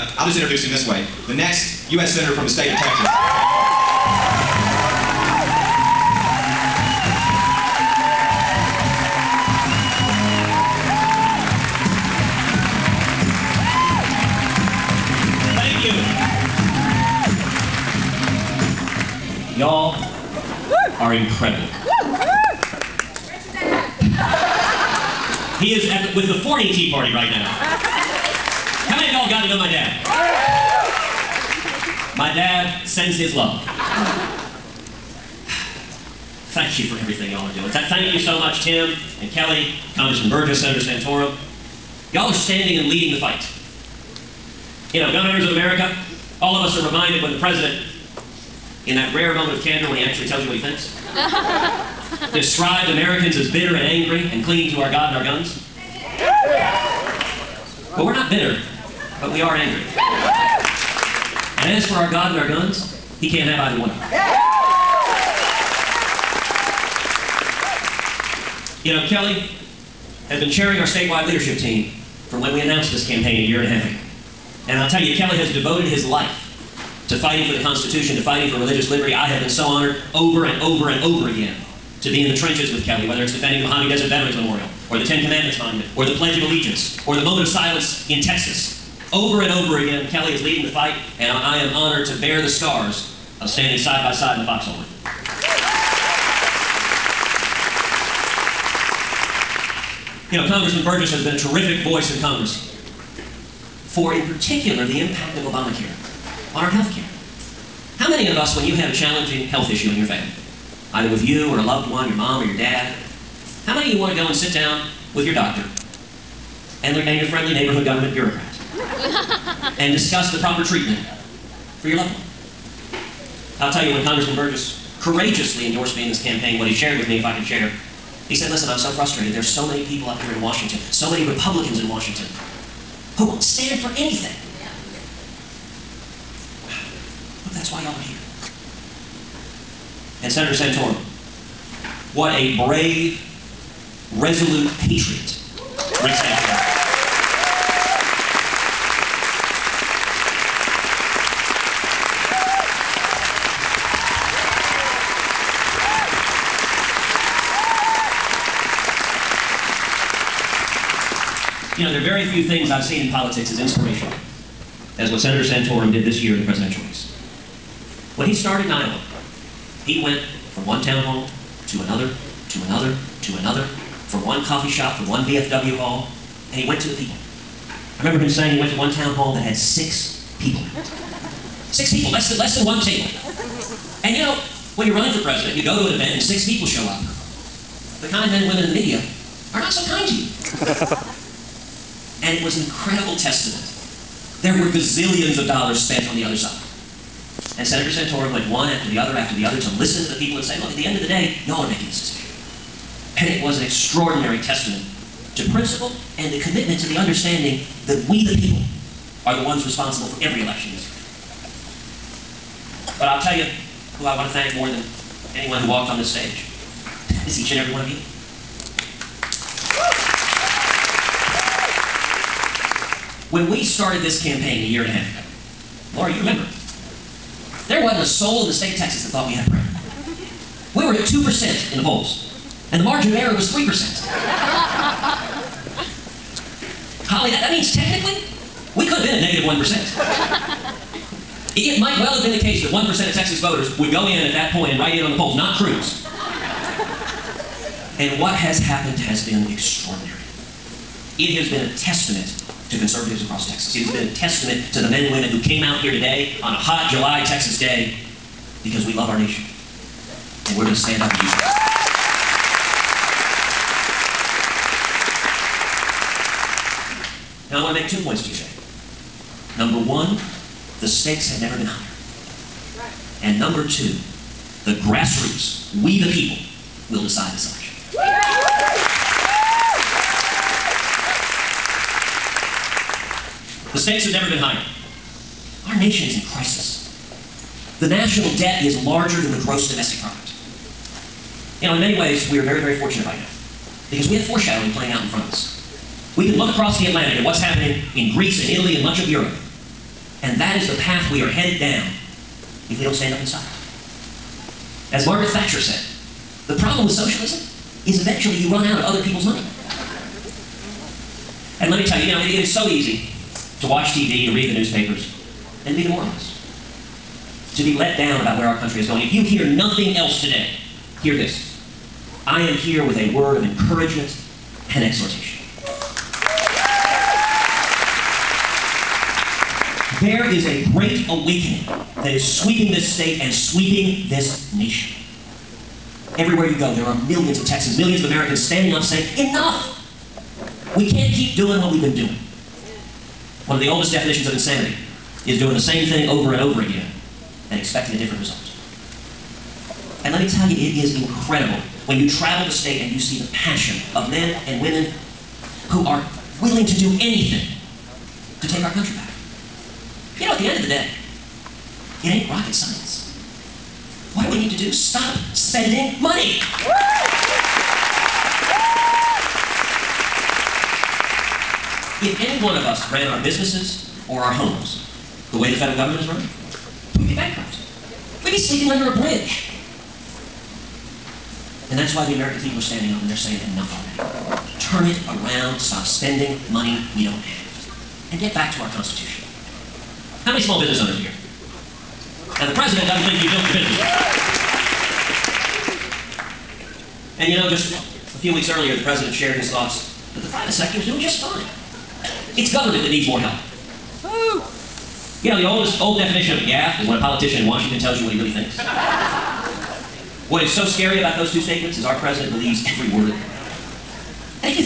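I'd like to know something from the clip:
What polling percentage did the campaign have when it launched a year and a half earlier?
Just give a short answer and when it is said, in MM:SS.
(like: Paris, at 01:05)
2%, at 03:51.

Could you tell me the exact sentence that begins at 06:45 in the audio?
You know, the oldest old definition of a gaffe is when a politician in Washington tells you what he really thinks.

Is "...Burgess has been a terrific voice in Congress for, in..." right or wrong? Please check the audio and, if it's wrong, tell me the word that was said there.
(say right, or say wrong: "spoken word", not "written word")
right.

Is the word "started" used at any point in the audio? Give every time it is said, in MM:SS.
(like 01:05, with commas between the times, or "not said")
02:48, 03:43.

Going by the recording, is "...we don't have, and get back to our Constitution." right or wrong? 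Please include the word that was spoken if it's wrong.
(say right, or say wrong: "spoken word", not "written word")
right.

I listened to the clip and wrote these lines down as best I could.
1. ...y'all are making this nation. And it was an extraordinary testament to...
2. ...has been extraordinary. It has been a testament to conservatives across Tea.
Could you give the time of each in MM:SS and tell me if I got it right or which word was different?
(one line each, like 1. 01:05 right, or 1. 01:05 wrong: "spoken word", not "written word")
1. 03:21 wrong: "decision", not "nation"
2. 04:08 wrong: "Texas", not "Tea".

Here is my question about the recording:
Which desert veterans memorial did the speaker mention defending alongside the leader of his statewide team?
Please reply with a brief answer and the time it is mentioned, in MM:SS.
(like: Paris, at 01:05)
Mojave Desert Veterans Memorial, at 01:23.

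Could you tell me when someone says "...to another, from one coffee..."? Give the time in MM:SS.
02:53.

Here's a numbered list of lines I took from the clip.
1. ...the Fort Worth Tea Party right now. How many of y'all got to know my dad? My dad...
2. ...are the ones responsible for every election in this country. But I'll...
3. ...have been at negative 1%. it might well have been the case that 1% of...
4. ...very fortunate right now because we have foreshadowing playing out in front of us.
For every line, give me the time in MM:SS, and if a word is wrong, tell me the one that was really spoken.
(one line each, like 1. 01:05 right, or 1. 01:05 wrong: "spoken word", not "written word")
1. 00:26 right
2. 03:29 right
3. 03:58 right
4. 04:52 right.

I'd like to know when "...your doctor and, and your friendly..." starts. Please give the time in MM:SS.
01:55.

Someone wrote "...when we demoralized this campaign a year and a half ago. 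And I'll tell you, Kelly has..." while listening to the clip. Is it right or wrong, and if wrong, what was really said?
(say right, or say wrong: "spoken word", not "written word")
wrong: "announced", not "demoralized".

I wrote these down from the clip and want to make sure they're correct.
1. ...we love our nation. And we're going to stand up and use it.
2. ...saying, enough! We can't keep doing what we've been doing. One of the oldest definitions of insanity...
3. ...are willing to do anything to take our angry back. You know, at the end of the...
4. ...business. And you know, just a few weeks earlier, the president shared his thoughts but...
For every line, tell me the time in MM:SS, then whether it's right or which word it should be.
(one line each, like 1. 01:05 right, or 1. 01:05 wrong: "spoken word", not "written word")
1. 04:18 right
2. 05:38 right
3. 05:55 wrong: "country", not "angry"
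4. 06:33 right.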